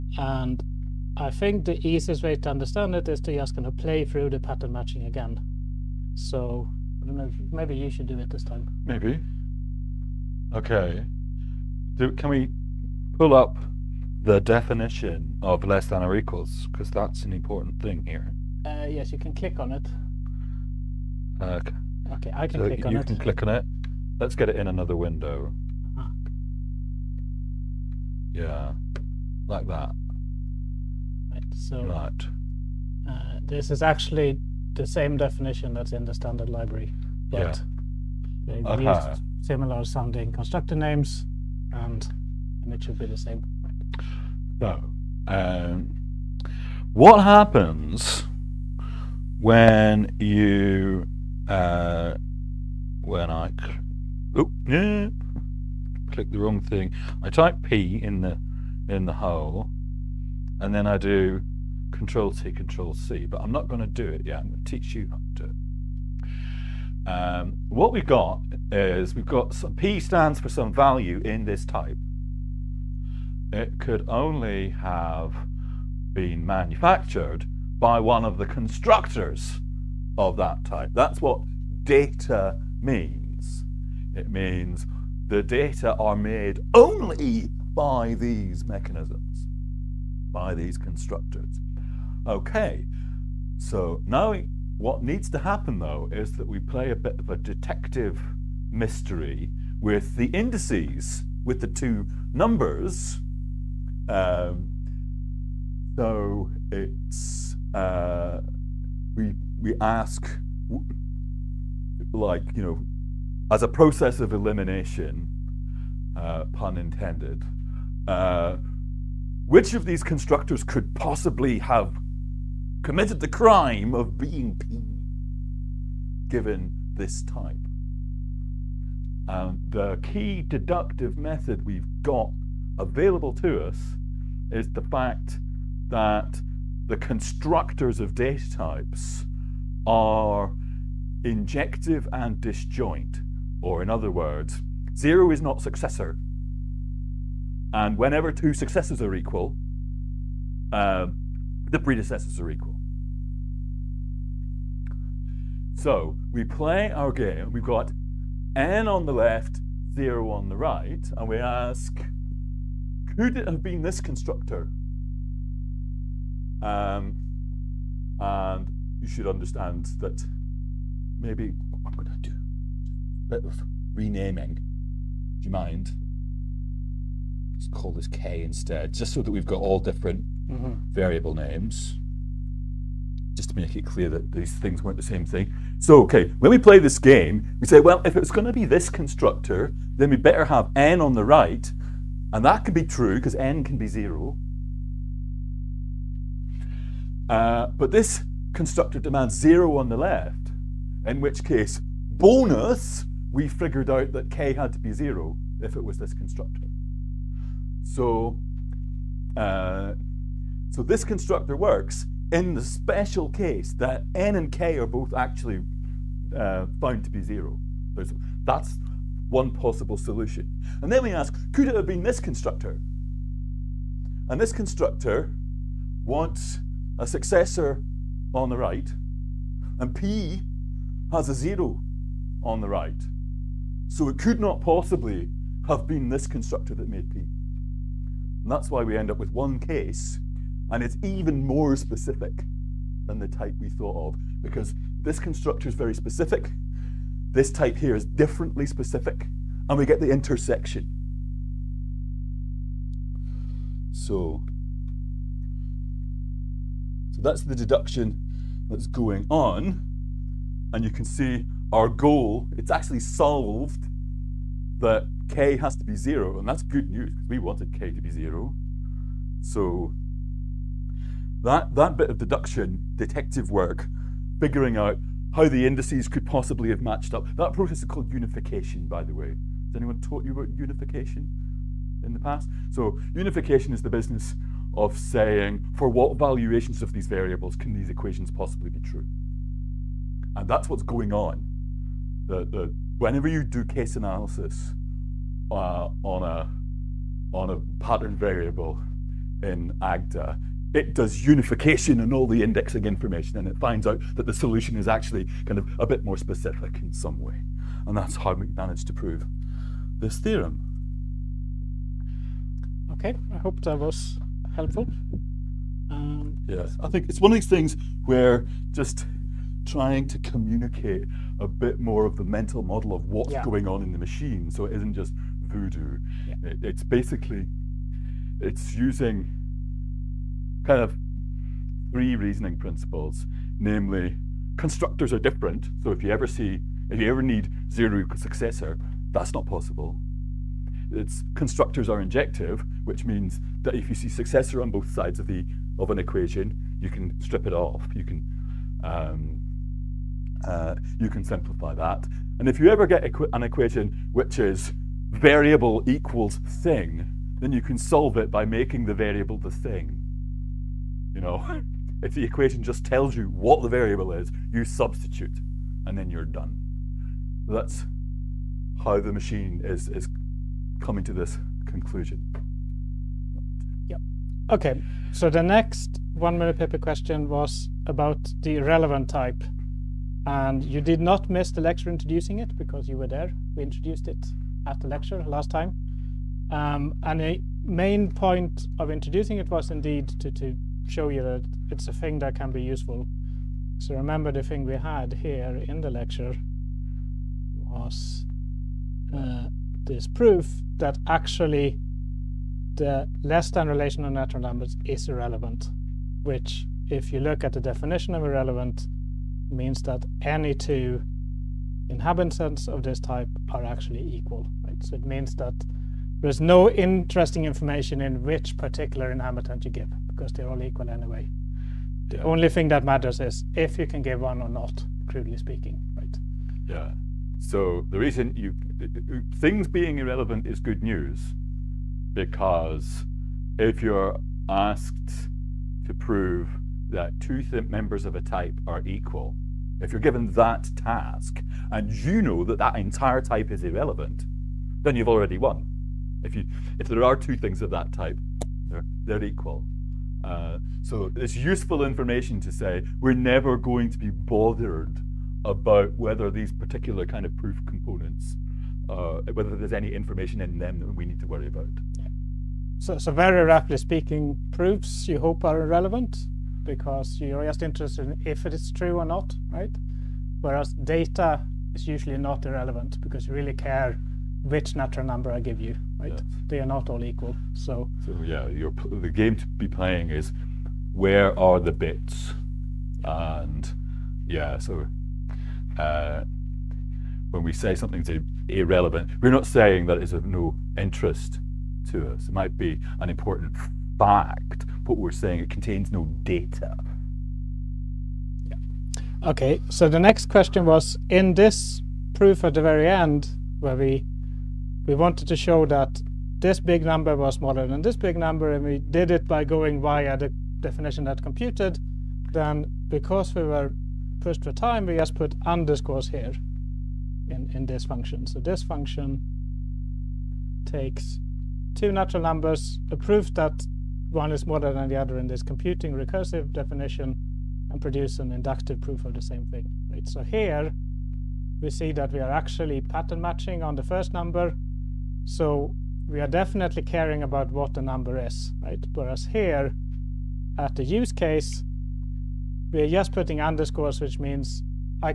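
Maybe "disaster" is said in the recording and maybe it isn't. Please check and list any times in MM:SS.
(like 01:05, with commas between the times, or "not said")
not said.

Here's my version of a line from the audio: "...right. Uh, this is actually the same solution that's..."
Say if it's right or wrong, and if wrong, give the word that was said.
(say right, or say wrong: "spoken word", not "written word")
wrong: "definition", not "solution".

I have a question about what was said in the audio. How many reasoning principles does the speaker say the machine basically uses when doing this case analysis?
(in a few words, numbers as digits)
three.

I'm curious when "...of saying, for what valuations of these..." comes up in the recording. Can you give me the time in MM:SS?
04:44.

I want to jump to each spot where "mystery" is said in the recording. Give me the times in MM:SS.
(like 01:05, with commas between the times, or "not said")
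01:38.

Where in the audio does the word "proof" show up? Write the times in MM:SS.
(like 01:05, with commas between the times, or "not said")
06:40, 07:37, 07:44, 08:22, 08:42, 08:48.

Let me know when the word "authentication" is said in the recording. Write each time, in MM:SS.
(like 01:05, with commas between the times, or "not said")
not said.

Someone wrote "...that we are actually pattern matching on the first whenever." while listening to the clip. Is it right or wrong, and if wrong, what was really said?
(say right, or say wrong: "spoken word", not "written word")
wrong: "number", not "whenever".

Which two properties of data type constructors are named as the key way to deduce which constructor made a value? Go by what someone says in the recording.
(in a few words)
injective and disjoint.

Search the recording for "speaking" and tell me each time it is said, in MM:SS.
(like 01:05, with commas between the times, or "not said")
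07:05, 07:43.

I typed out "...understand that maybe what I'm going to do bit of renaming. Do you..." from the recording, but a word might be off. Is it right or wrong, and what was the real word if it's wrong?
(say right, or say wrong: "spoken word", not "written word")
right.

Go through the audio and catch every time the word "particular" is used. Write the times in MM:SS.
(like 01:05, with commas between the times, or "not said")
06:58, 07:36.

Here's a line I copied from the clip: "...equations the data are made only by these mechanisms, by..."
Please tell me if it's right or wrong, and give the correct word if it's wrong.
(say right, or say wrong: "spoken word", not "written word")
wrong: "means", not "equations".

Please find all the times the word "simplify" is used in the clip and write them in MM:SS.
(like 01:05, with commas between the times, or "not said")
05:51.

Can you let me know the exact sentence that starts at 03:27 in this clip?
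So, uh, so this constructor works in the special case that n and k are both actually uh, found to be zero.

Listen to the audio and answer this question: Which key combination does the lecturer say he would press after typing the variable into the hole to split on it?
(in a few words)
Control T, Control C.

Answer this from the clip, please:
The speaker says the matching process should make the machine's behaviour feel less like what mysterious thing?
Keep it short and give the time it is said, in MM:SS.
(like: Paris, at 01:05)
voodoo, at 05:25.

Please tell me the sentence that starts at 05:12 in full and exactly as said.
Okay, I hope that was helpful.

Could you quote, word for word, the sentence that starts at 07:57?
So, so yeah, the game to be playing is where are the bits?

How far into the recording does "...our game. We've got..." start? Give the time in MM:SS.
02:36.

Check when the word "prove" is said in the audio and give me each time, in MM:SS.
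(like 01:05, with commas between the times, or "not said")
05:08, 07:15.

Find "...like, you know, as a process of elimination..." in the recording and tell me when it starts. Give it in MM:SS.
01:52.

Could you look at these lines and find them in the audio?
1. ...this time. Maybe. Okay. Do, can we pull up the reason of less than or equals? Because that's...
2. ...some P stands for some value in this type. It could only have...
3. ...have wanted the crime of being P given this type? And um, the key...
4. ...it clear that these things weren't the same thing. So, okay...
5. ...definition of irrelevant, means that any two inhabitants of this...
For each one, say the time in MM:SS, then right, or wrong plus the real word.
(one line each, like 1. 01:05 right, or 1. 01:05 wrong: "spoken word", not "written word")
1. 00:08 wrong: "definition", not "reason"
2. 01:09 right
3. 02:01 wrong: "committed", not "wanted"
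4. 03:03 right
5. 06:47 right.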